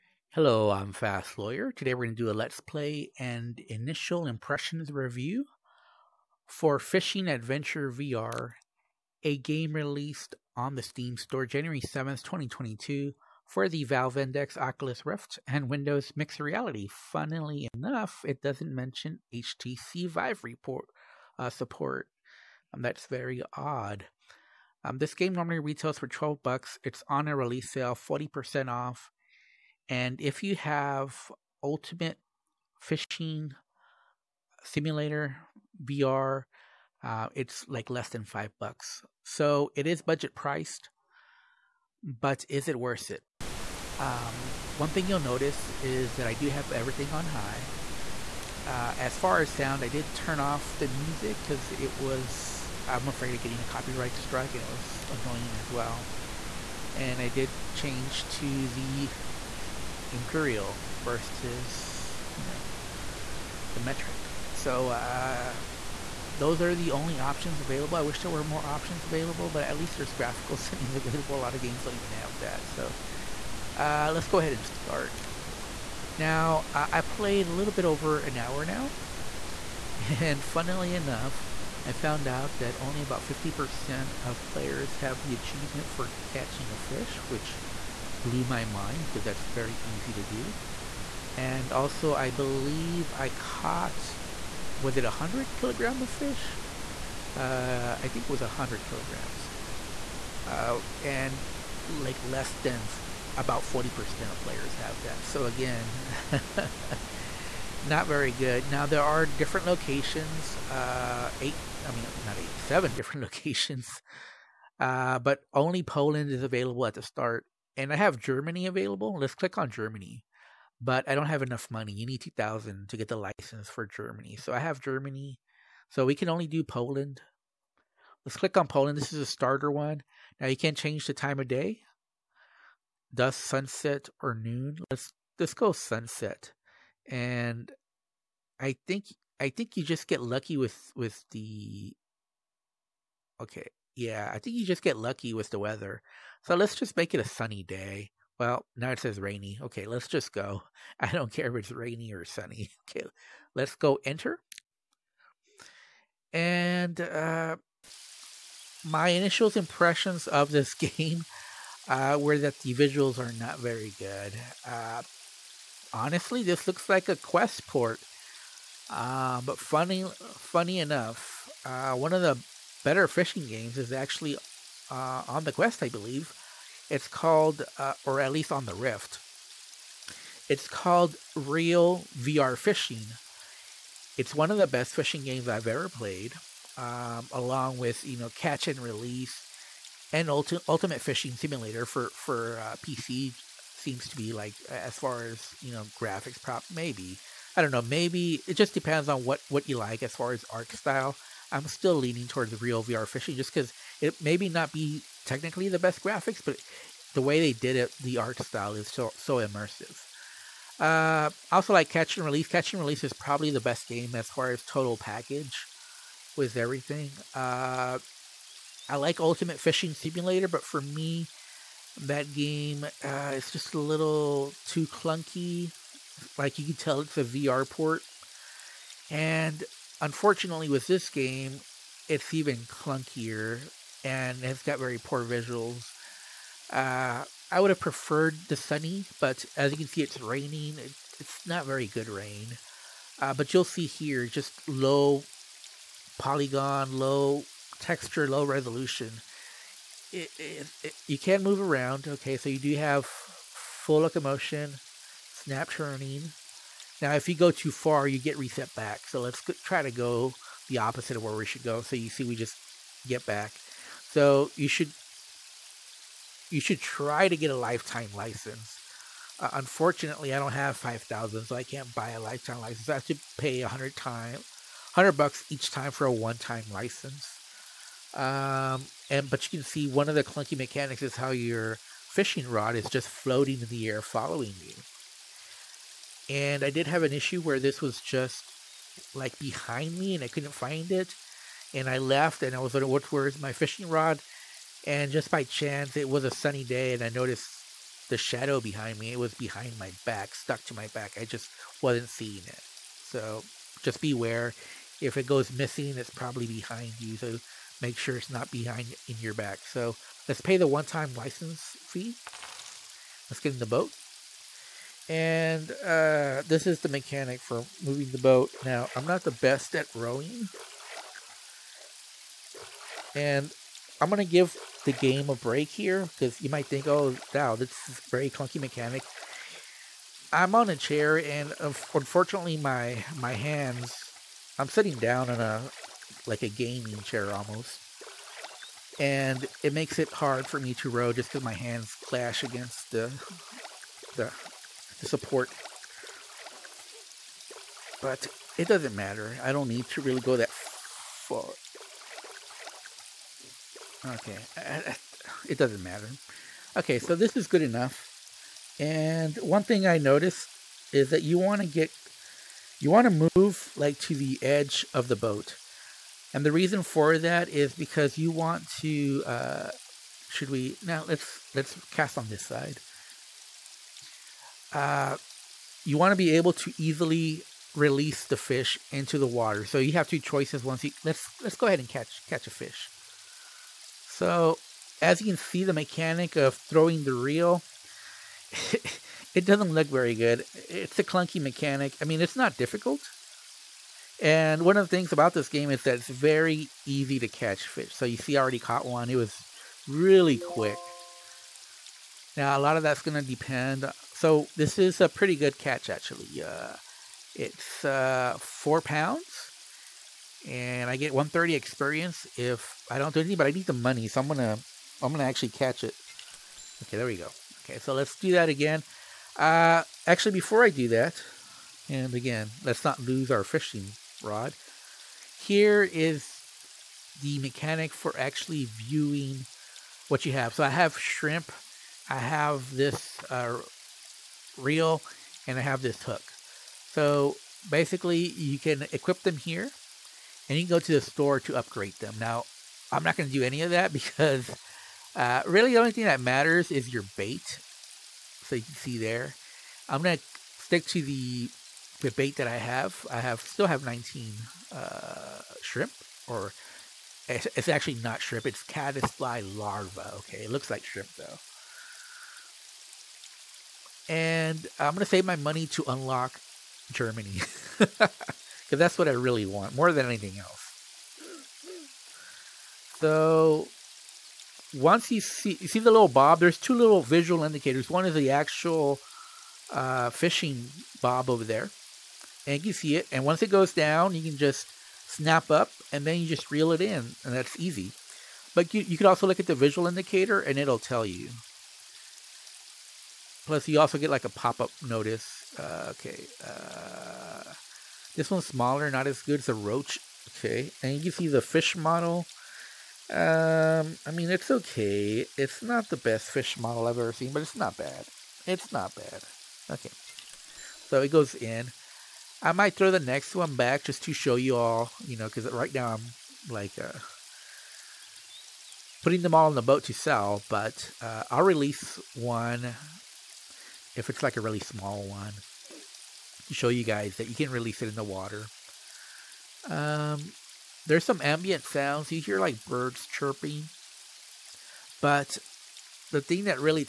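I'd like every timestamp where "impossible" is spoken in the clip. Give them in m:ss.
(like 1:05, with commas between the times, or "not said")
not said.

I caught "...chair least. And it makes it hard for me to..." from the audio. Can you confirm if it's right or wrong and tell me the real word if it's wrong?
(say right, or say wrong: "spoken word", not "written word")
wrong: "almost", not "least".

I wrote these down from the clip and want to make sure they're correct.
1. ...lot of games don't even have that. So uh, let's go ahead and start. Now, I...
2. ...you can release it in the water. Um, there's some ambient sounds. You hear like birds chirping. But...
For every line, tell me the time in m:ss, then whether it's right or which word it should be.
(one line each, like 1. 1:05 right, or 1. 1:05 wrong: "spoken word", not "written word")
1. 1:11 right
2. 8:47 right.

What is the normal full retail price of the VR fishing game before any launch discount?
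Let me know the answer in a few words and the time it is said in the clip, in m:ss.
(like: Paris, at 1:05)
12 bucks, at 0:26.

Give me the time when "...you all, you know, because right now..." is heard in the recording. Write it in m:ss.
8:34.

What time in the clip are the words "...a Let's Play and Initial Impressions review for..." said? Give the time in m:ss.
0:02.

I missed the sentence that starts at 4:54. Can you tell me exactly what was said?
And just by chance, it was a sunny day and I noticed the shadow behind me.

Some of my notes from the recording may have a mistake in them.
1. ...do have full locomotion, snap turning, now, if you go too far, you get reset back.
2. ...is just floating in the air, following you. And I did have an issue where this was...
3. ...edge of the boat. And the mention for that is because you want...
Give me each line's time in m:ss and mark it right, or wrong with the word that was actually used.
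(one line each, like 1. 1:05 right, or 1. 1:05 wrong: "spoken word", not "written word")
1. 4:12 right
2. 4:42 right
3. 6:04 wrong: "reason", not "mention".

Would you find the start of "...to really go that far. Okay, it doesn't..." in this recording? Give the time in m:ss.
5:49.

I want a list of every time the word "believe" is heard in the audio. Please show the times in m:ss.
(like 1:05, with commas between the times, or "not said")
1:32, 2:55.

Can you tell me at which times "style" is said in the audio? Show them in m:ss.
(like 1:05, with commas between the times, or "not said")
3:20, 3:28.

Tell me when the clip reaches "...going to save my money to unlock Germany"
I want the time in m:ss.
7:44.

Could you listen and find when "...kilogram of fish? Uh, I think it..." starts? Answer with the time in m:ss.
1:35.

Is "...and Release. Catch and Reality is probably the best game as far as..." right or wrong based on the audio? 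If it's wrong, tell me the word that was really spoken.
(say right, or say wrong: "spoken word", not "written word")
wrong: "Release", not "Reality".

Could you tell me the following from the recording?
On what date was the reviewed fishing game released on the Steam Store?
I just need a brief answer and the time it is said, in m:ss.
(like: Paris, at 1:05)
January 7th, 2022, at 0:11.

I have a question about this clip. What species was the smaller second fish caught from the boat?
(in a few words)
roach.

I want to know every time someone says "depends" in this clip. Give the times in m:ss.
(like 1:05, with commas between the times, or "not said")
3:18, 6:43.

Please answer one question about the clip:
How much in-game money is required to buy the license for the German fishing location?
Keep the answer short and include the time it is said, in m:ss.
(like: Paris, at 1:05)
2000, at 2:02.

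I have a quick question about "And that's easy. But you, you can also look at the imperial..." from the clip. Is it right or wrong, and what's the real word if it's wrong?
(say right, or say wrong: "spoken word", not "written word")
wrong: "visual", not "imperial".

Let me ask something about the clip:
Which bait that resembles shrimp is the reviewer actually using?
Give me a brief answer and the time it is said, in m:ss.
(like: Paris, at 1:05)
caddisfly larva, at 7:38.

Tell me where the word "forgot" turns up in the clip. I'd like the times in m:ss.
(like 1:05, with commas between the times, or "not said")
not said.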